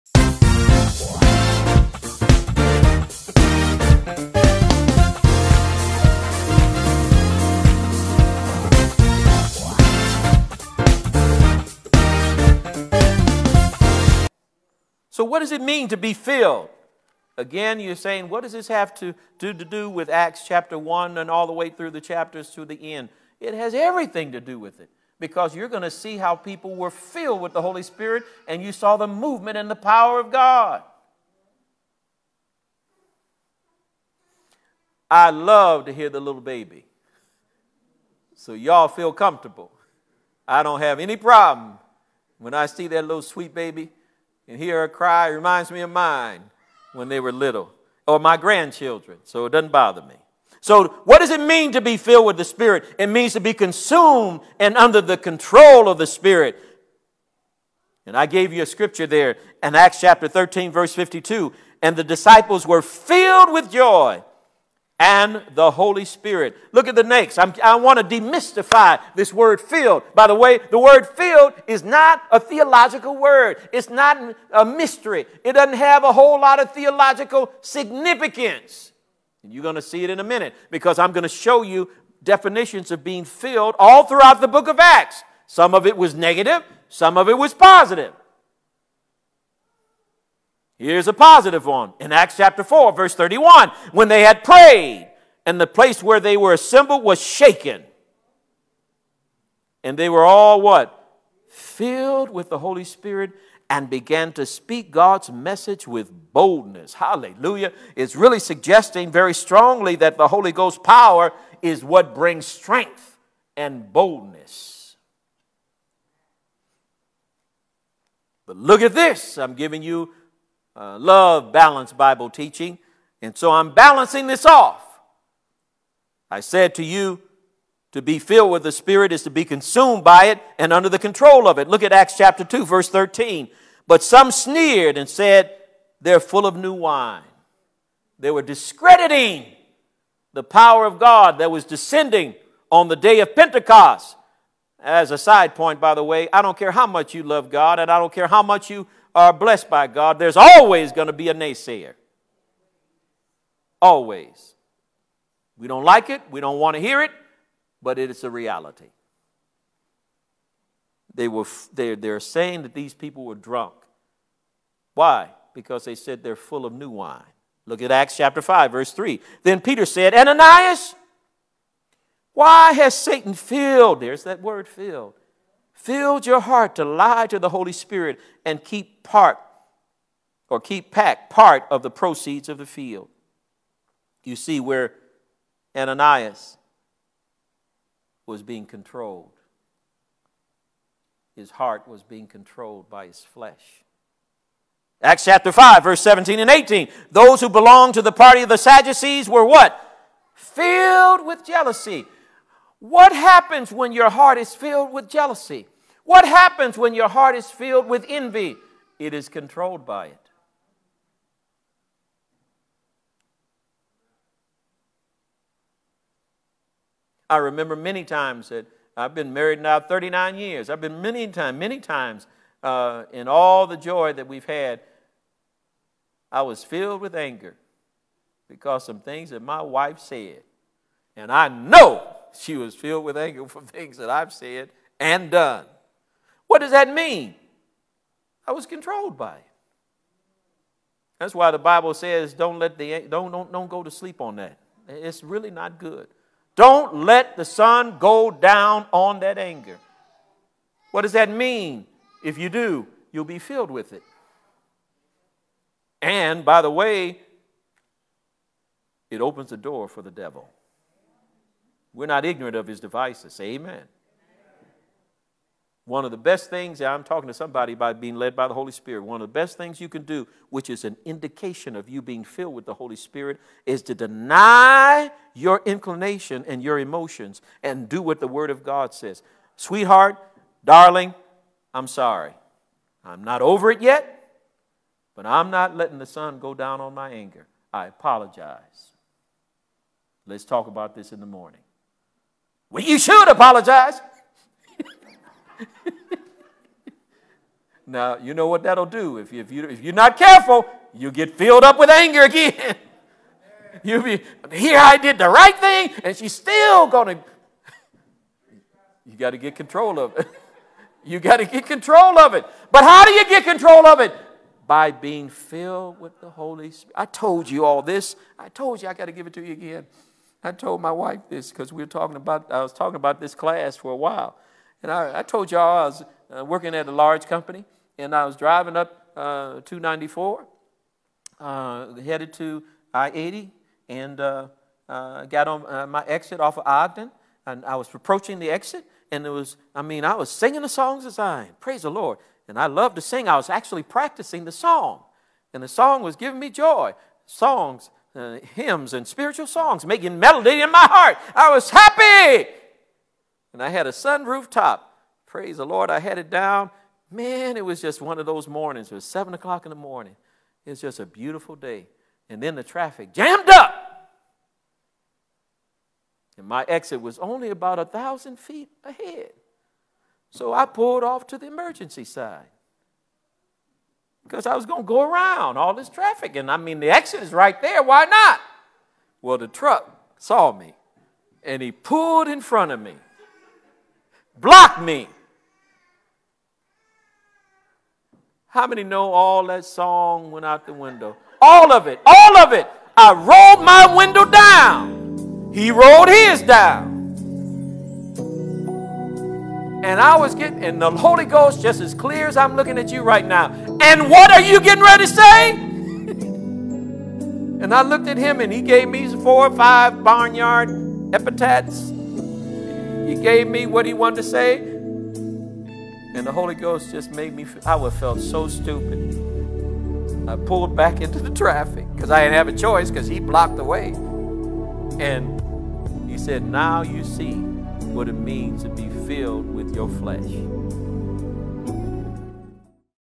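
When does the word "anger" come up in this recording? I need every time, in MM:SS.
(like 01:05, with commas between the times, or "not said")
03:47, 03:53, 04:09, 04:47, 05:01.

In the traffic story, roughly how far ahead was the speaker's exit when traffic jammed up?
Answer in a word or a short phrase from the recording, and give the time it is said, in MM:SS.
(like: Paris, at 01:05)
1,000 feet, at 06:07.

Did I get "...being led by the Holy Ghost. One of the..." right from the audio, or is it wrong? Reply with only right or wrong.
wrong.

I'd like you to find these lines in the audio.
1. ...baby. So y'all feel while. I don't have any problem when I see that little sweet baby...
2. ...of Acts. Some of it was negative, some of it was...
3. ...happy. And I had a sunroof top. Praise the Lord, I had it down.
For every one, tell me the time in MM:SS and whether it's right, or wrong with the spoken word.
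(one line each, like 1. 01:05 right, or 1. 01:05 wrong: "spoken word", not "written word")
1. 00:36 wrong: "comfortable", not "while"
2. 01:24 right
3. 05:51 right.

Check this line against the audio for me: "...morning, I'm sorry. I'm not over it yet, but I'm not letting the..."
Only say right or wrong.
wrong.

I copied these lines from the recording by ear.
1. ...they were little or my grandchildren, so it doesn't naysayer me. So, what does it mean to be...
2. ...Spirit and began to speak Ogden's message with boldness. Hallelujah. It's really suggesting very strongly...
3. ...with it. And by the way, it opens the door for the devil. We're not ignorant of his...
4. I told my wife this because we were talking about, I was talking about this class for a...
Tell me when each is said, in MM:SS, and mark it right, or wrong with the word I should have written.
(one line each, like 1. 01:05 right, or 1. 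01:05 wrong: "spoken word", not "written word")
1. 00:47 wrong: "bother", not "naysayer"
2. 01:42 wrong: "God", not "Ogden"
3. 04:13 right
4. 05:20 right.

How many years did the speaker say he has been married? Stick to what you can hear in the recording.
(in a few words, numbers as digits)
39.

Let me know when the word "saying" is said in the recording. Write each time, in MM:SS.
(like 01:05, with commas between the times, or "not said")
00:17, 02:42.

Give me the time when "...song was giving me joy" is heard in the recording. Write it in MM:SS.
05:45.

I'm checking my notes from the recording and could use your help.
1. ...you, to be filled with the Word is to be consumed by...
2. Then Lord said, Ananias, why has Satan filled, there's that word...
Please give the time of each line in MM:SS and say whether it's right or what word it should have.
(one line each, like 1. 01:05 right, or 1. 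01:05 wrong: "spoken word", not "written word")
1. 02:06 wrong: "Spirit", not "Word"
2. 02:49 wrong: "Peter", not "Lord".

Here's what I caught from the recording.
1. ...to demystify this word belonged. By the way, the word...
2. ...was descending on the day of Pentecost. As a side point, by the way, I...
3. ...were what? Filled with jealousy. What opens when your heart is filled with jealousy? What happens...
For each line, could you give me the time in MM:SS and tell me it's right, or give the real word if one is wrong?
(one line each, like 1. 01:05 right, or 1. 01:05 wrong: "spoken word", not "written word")
1. 01:07 wrong: "filled", not "belonged"
2. 02:21 right
3. 03:19 wrong: "happens", not "opens".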